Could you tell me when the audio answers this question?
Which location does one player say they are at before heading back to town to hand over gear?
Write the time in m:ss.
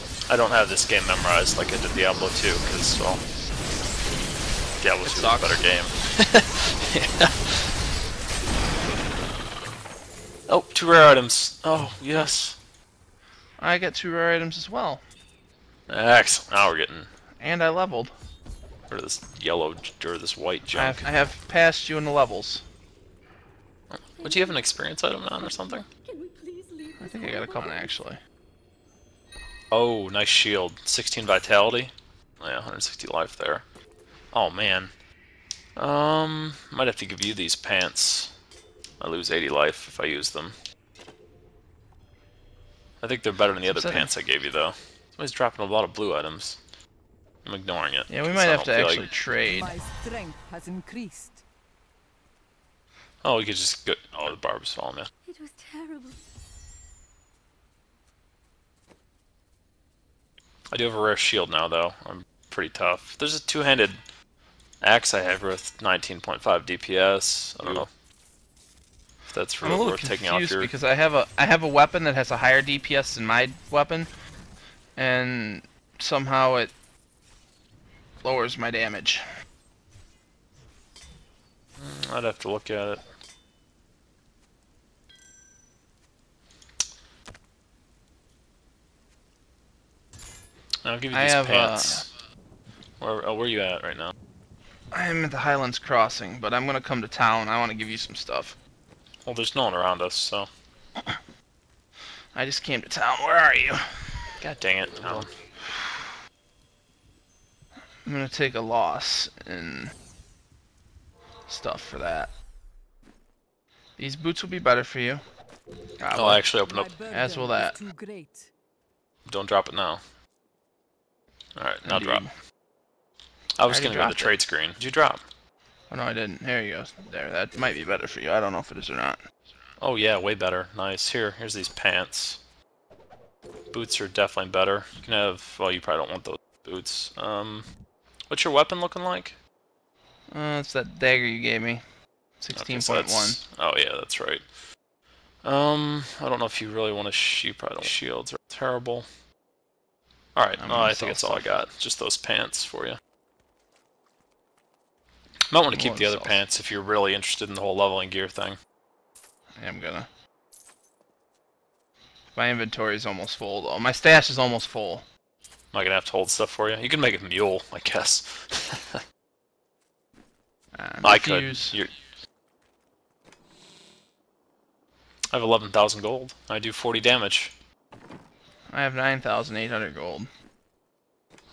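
1:35.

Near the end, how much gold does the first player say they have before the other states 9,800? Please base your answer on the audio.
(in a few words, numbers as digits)
11,000.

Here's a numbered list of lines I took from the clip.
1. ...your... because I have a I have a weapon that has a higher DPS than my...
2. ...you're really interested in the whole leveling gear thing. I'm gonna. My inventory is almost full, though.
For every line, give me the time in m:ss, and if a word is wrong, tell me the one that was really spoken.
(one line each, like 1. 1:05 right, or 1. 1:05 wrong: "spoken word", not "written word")
1. 1:10 right
2. 2:36 right.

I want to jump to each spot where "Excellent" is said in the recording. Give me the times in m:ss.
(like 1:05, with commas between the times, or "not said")
0:15.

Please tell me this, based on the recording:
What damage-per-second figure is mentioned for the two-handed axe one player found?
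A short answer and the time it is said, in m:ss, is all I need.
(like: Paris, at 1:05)
19.5, at 1:05.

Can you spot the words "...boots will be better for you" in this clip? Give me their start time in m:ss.
1:54.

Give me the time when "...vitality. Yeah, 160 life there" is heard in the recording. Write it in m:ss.
0:31.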